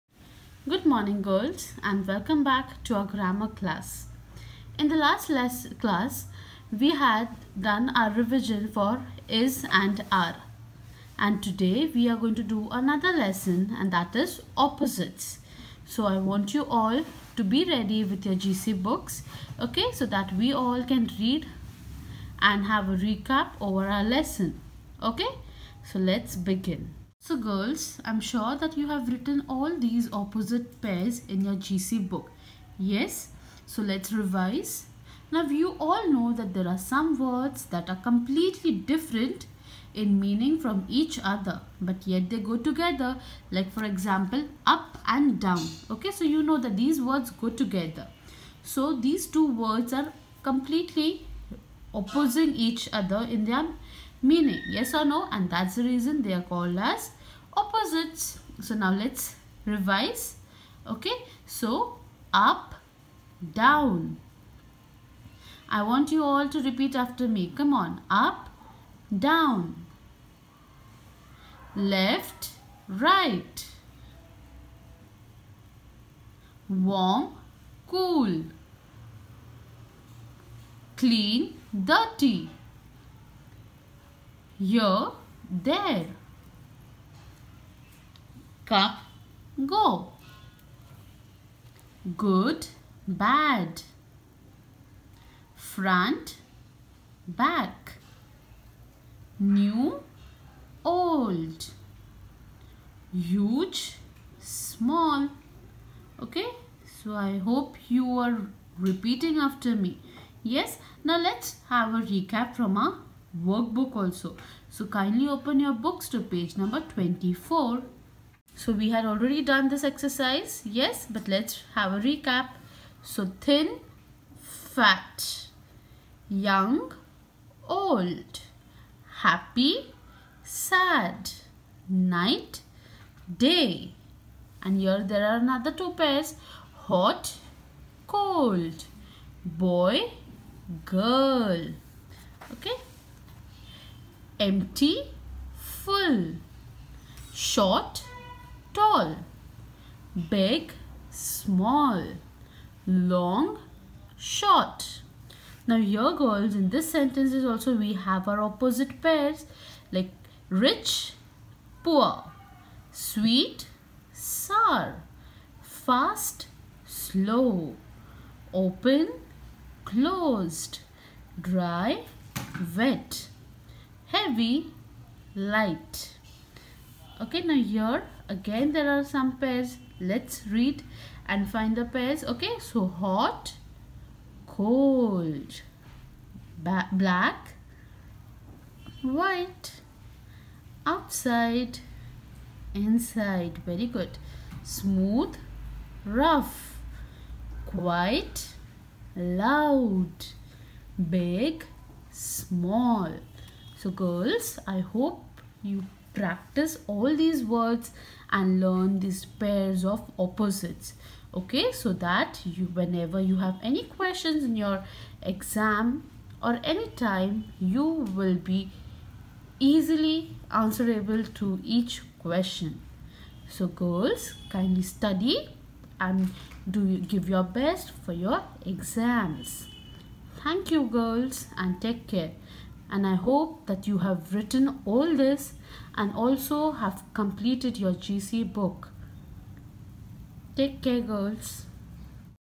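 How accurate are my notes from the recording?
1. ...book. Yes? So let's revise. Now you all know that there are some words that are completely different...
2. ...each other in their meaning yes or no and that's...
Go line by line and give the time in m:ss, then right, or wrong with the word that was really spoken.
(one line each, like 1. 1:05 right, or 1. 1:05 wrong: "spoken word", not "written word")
1. 0:32 right
2. 0:52 right.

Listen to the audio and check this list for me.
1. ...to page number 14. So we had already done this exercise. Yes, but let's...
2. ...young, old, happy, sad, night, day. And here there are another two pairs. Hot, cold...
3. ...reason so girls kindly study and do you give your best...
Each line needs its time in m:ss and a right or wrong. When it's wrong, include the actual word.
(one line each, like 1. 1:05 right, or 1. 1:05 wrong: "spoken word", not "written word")
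1. 1:56 wrong: "24", not "14"
2. 2:06 right
3. 3:42 wrong: "question", not "reason".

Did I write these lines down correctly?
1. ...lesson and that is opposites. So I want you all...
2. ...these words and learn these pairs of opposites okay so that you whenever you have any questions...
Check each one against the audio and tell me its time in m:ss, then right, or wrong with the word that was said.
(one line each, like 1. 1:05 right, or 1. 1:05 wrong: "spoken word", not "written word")
1. 0:13 right
2. 3:27 right.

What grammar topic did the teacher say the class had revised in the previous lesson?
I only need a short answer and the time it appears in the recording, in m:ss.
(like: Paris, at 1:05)
is and are, at 0:09.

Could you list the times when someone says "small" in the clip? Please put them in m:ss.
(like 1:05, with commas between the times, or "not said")
1:44, 2:31, 3:22.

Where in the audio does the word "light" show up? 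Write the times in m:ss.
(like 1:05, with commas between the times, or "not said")
2:55.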